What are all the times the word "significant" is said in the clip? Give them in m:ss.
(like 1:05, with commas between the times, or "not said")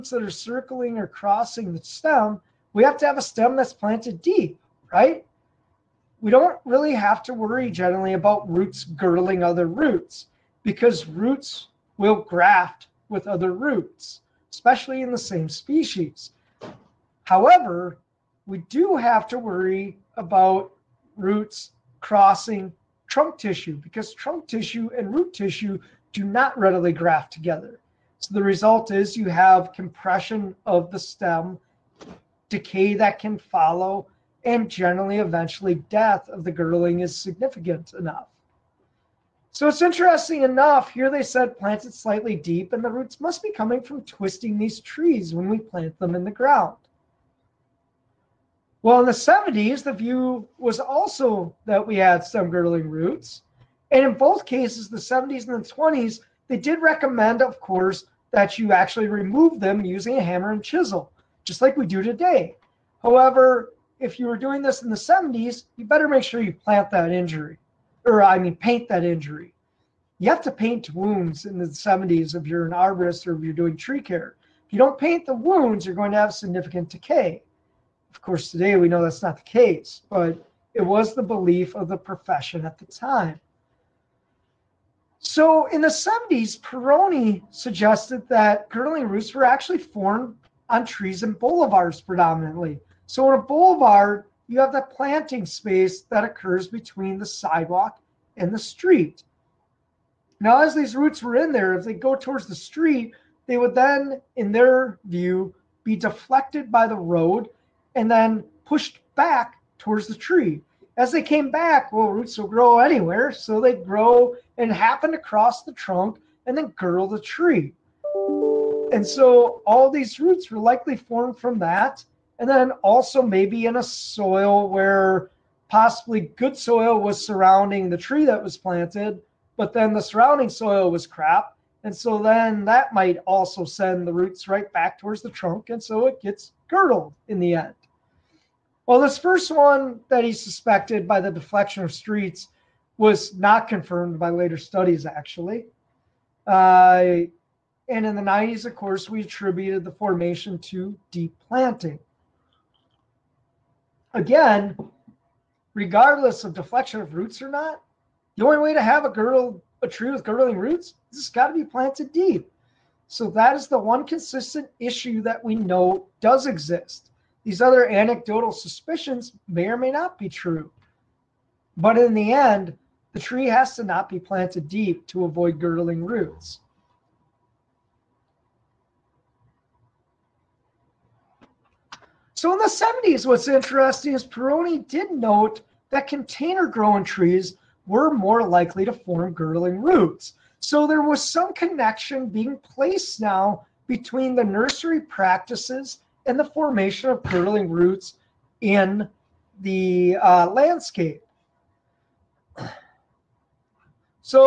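0:37, 1:16.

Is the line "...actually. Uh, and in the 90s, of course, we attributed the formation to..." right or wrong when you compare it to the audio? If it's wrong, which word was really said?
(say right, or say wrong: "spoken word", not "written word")
right.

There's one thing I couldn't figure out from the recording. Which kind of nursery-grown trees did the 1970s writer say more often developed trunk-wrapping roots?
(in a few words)
container growing trees.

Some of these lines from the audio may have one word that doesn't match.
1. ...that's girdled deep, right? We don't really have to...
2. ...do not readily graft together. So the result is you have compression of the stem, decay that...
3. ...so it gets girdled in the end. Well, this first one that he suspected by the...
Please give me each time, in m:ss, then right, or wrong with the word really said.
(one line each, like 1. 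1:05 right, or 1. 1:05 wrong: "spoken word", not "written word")
1. 0:03 wrong: "planted", not "girdled"
2. 0:26 right
3. 2:15 right.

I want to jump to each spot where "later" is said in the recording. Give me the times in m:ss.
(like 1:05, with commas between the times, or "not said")
2:24.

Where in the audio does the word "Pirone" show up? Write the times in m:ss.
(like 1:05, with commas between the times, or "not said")
1:26, 3:04.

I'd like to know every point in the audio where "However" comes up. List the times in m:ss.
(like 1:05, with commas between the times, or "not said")
0:17, 1:03.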